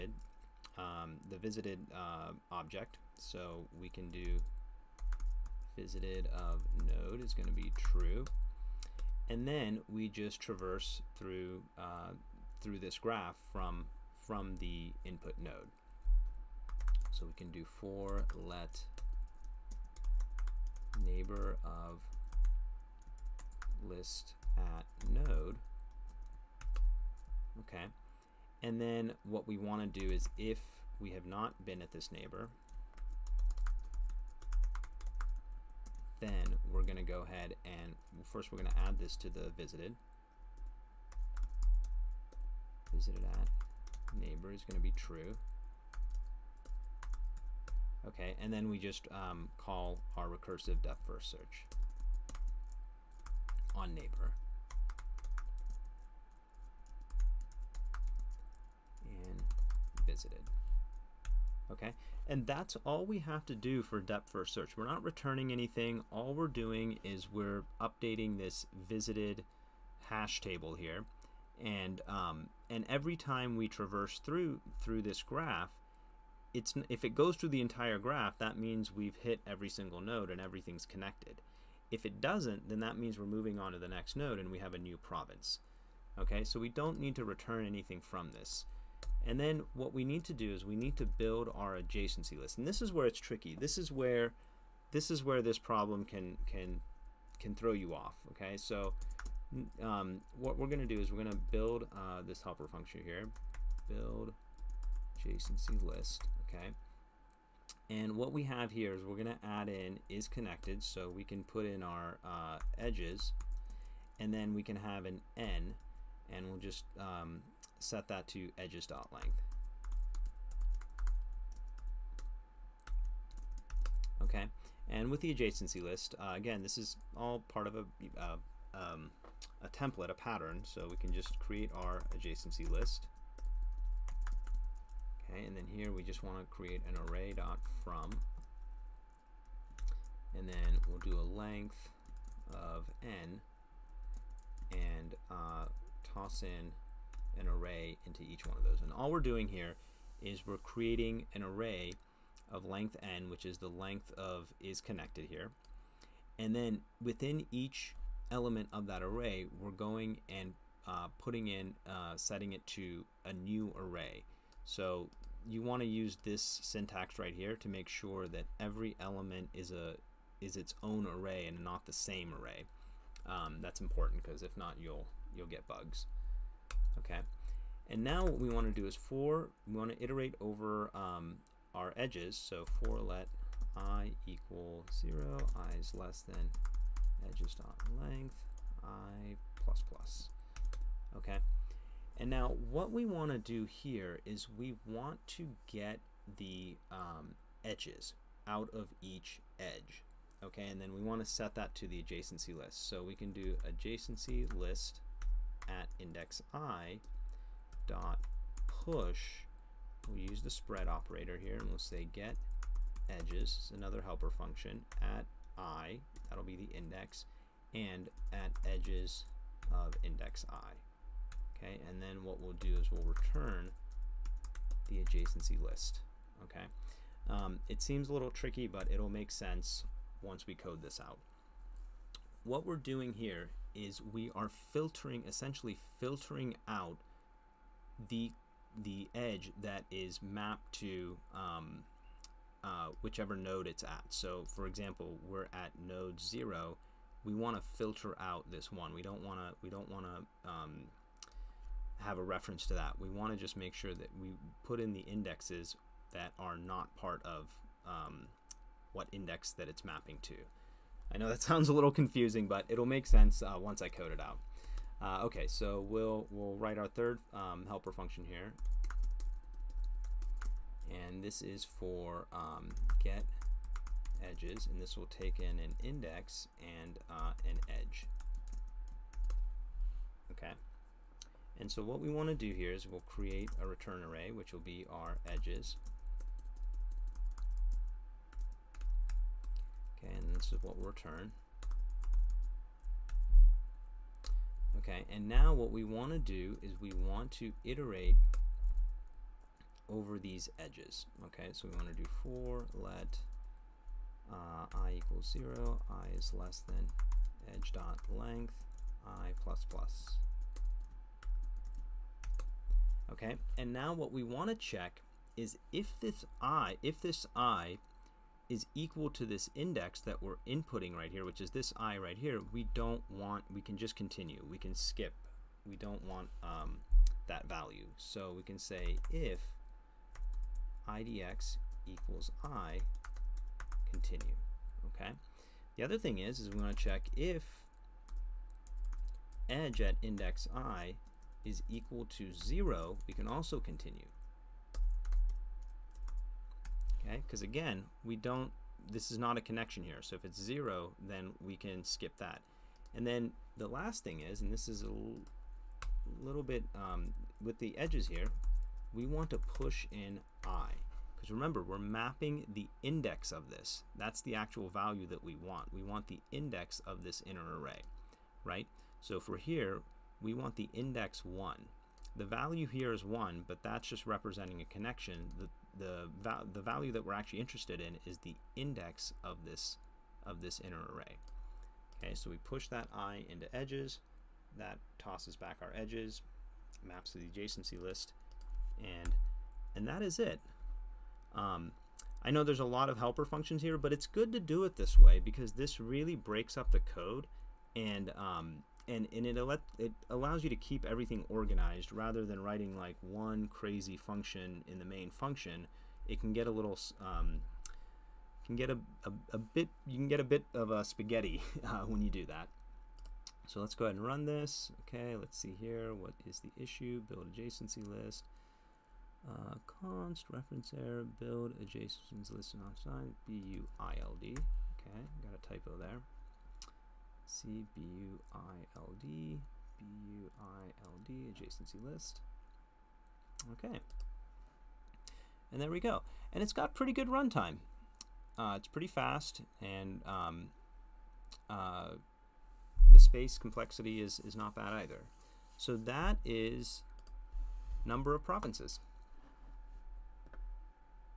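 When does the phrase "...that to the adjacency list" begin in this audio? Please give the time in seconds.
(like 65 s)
201 s.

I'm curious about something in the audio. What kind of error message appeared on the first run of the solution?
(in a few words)
reference error.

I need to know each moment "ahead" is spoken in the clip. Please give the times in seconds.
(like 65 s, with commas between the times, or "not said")
37 s, 413 s.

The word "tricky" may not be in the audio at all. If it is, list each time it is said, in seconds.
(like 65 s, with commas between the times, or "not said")
93 s, 228 s.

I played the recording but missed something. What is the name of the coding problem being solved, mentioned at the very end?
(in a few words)
Number of Provinces.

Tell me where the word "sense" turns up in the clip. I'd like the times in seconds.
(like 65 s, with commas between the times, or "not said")
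229 s, 263 s.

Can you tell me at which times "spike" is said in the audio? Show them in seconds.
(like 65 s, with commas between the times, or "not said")
not said.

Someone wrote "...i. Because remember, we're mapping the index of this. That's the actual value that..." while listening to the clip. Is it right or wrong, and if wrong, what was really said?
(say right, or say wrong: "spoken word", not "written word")
right.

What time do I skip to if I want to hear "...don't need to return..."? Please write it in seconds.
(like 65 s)
86 s.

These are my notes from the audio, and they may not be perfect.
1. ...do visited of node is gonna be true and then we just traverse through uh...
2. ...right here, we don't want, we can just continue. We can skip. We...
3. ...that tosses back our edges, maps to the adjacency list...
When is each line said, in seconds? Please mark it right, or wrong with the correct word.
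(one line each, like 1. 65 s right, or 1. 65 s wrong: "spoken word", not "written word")
1. 4 s right
2. 321 s right
3. 384 s right.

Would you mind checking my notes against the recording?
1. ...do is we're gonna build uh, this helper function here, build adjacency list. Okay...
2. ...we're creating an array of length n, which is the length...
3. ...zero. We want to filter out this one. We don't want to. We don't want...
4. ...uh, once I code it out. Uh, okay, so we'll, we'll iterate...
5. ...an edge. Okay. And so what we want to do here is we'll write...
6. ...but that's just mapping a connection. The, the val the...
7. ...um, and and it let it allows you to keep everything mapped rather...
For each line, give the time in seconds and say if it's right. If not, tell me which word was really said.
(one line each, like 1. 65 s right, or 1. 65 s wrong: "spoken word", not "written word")
1. 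100 s right
2. 150 s right
3. 246 s right
4. 263 s wrong: "write", not "iterate"
5. 277 s wrong: "create", not "write"
6. 373 s wrong: "representing", not "mapping"
7. 398 s wrong: "organized", not "mapped".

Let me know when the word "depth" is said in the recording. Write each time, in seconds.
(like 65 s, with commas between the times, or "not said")
50 s, 63 s.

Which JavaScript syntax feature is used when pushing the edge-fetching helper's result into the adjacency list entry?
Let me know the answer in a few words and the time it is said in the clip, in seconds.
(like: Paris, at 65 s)
spread operator, at 210 s.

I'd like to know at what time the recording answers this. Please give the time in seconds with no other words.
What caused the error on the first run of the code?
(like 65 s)
425 s.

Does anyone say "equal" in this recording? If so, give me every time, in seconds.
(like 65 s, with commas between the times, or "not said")
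184 s, 304 s, 318 s, 331 s, 341 s.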